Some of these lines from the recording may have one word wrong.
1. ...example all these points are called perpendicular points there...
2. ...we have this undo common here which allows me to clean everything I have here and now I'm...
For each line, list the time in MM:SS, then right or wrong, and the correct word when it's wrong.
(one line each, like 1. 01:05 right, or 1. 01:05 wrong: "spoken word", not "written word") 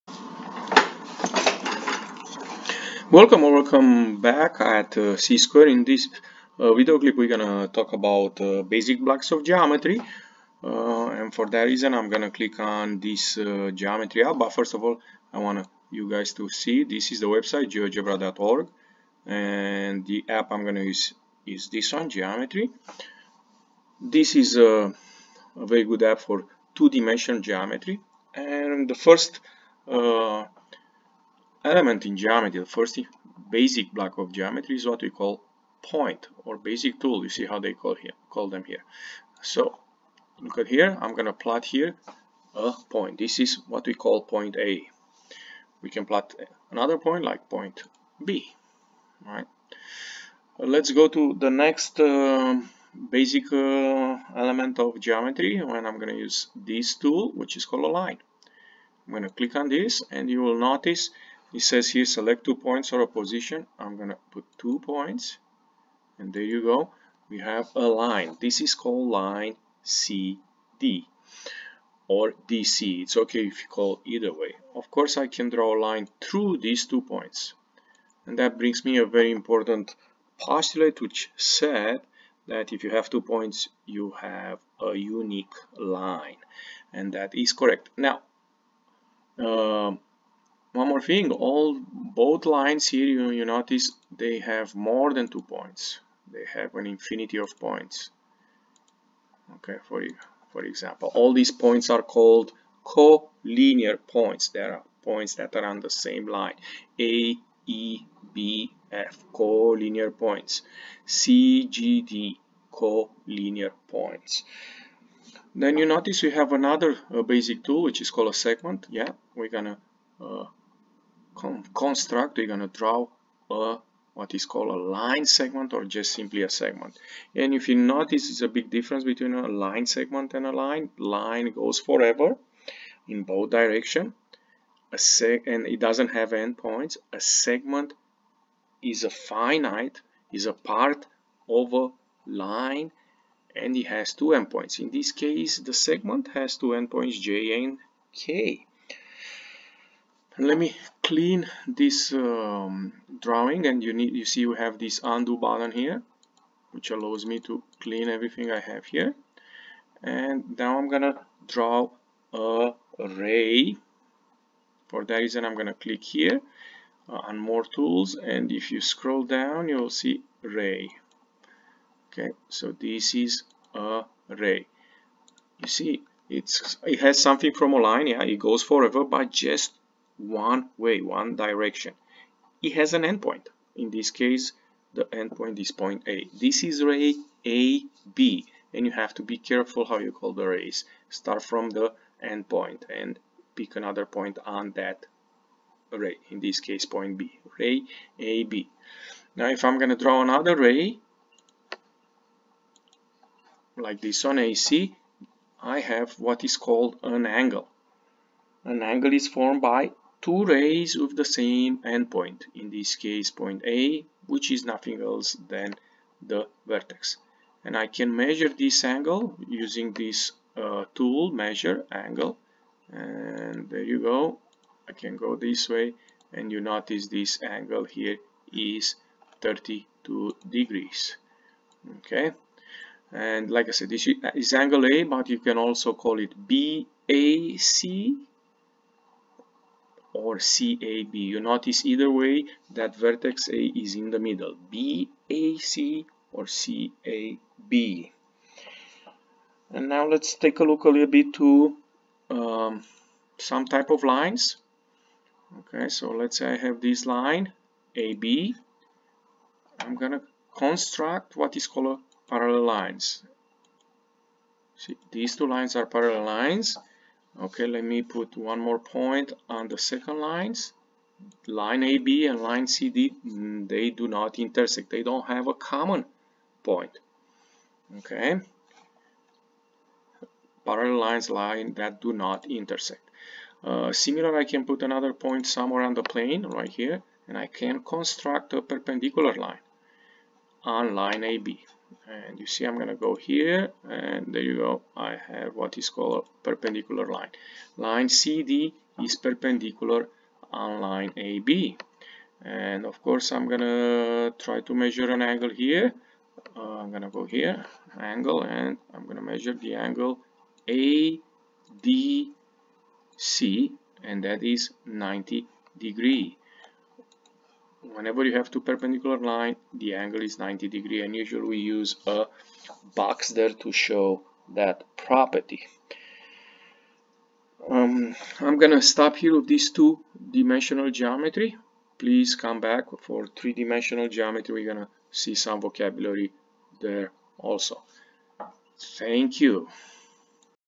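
1. 01:40 wrong: "collinear", not "perpendicular"
2. 02:34 wrong: "button", not "common".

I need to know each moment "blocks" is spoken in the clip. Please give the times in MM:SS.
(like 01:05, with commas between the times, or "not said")
00:09, 00:33.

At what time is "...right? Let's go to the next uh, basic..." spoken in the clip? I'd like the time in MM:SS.
00:49.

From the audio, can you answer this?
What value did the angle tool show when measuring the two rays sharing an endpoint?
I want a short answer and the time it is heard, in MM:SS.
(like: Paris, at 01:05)
32 degrees, at 03:49.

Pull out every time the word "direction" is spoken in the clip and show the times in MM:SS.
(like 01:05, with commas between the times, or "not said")
02:13, 03:01.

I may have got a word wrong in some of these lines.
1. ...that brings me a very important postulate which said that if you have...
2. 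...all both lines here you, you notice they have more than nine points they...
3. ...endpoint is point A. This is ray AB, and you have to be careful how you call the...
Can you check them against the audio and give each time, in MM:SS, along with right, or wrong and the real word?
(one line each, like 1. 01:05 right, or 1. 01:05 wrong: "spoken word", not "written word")
1. 01:18 right
2. 01:31 wrong: "two", not "nine"
3. 03:05 right.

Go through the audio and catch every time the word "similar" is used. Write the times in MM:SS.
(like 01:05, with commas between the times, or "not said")
04:43.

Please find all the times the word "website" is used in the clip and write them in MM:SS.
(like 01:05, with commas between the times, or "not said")
00:17.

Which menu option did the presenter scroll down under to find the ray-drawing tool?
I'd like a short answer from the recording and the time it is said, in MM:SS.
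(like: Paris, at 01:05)
more tools, at 02:47.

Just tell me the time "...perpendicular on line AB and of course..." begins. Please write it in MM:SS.
04:59.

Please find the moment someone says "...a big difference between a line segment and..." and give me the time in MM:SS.
02:08.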